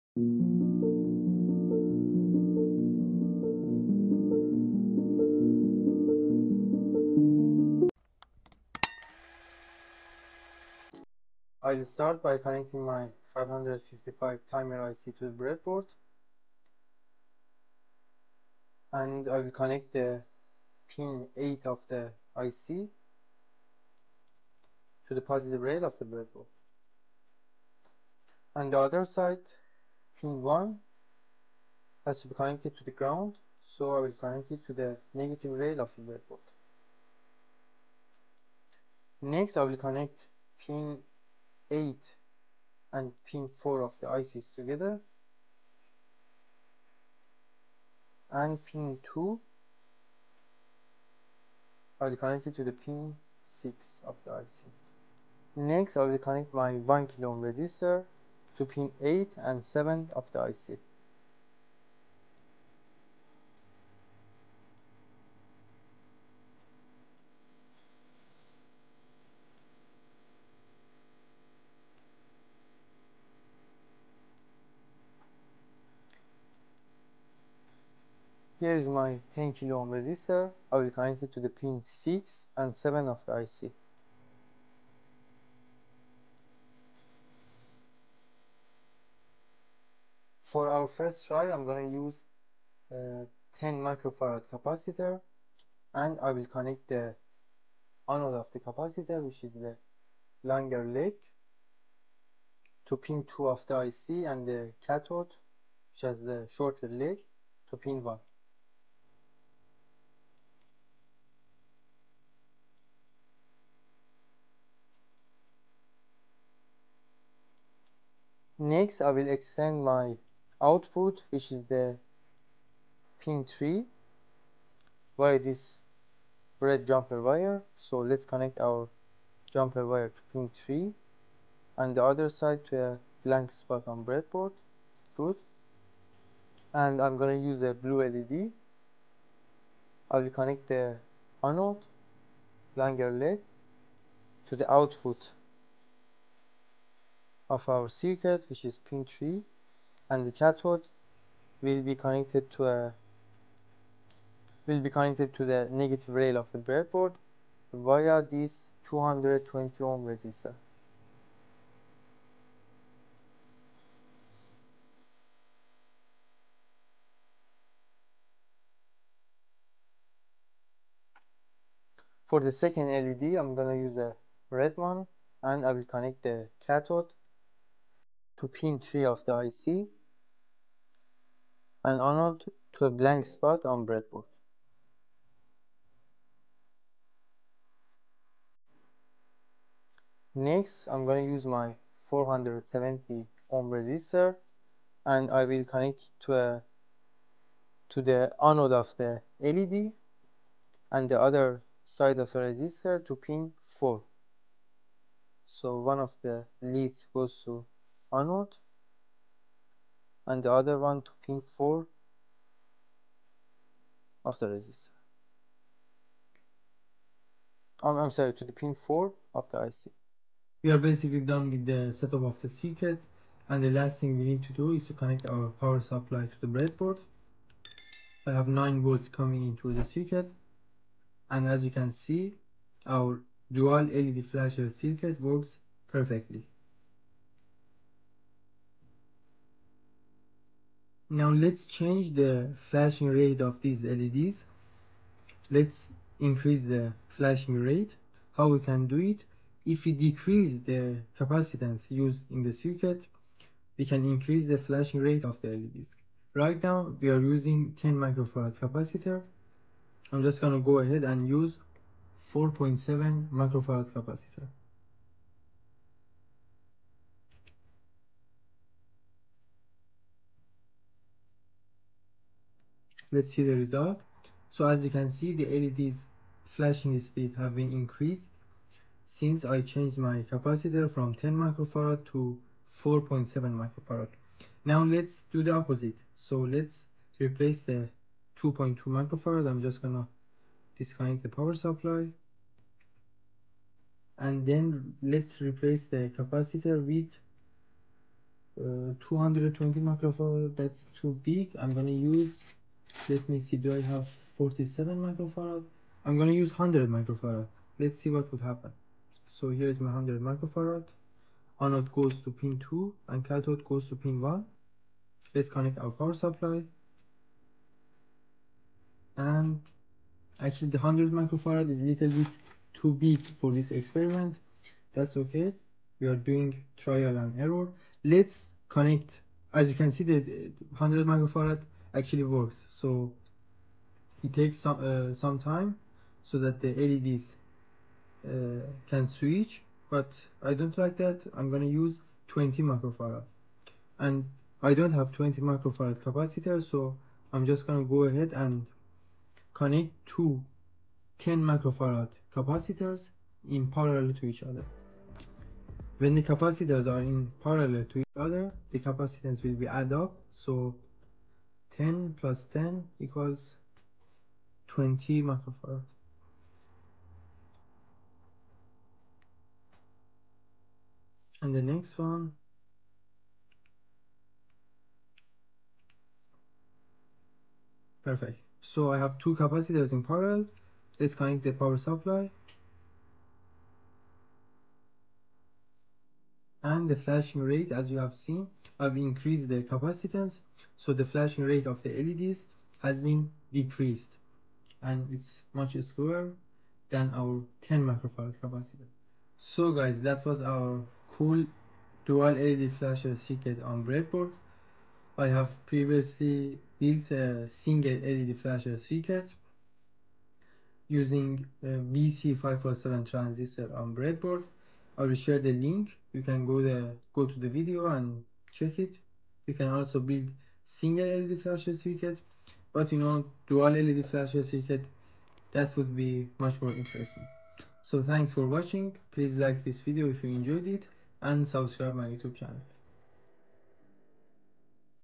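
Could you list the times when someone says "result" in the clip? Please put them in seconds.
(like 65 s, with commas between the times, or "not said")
273 s.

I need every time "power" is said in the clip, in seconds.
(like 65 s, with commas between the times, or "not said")
225 s, 291 s, 315 s, 381 s.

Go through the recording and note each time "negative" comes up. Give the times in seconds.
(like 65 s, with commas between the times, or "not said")
35 s, 155 s.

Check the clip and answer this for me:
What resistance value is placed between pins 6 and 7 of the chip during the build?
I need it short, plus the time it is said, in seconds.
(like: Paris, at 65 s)
10 kilo ohm, at 79 s.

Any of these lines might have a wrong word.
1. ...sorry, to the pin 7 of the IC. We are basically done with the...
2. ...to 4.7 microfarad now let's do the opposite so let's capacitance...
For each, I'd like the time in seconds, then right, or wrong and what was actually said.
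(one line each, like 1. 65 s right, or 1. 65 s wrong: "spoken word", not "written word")
1. 218 s wrong: "4", not "7"
2. 282 s wrong: "replace", not "capacitance".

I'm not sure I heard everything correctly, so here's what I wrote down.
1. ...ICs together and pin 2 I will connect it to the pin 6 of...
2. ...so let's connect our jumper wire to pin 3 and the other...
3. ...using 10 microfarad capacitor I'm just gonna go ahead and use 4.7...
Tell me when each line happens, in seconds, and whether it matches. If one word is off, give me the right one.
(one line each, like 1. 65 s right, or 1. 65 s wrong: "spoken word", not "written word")
1. 44 s right
2. 127 s right
3. 257 s right.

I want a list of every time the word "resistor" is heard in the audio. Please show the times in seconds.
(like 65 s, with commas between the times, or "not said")
57 s, 79 s, 160 s, 193 s, 202 s, 214 s.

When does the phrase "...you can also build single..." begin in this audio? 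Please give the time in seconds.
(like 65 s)
419 s.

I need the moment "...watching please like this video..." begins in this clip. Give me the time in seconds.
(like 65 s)
428 s.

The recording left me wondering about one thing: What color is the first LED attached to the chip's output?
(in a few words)
Blue.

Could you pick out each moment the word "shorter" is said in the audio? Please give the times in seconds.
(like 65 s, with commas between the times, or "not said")
106 s.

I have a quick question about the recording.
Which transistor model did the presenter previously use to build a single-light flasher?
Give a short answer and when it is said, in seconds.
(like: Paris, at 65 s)
BC547, at 411 s.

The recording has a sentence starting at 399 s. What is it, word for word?
So guys that was our cool dual LED flasher circuit on breadboard.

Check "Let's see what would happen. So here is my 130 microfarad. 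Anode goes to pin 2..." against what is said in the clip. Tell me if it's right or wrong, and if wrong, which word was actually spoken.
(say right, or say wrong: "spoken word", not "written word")
wrong: "100", not "130".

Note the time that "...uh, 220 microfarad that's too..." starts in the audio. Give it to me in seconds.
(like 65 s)
298 s.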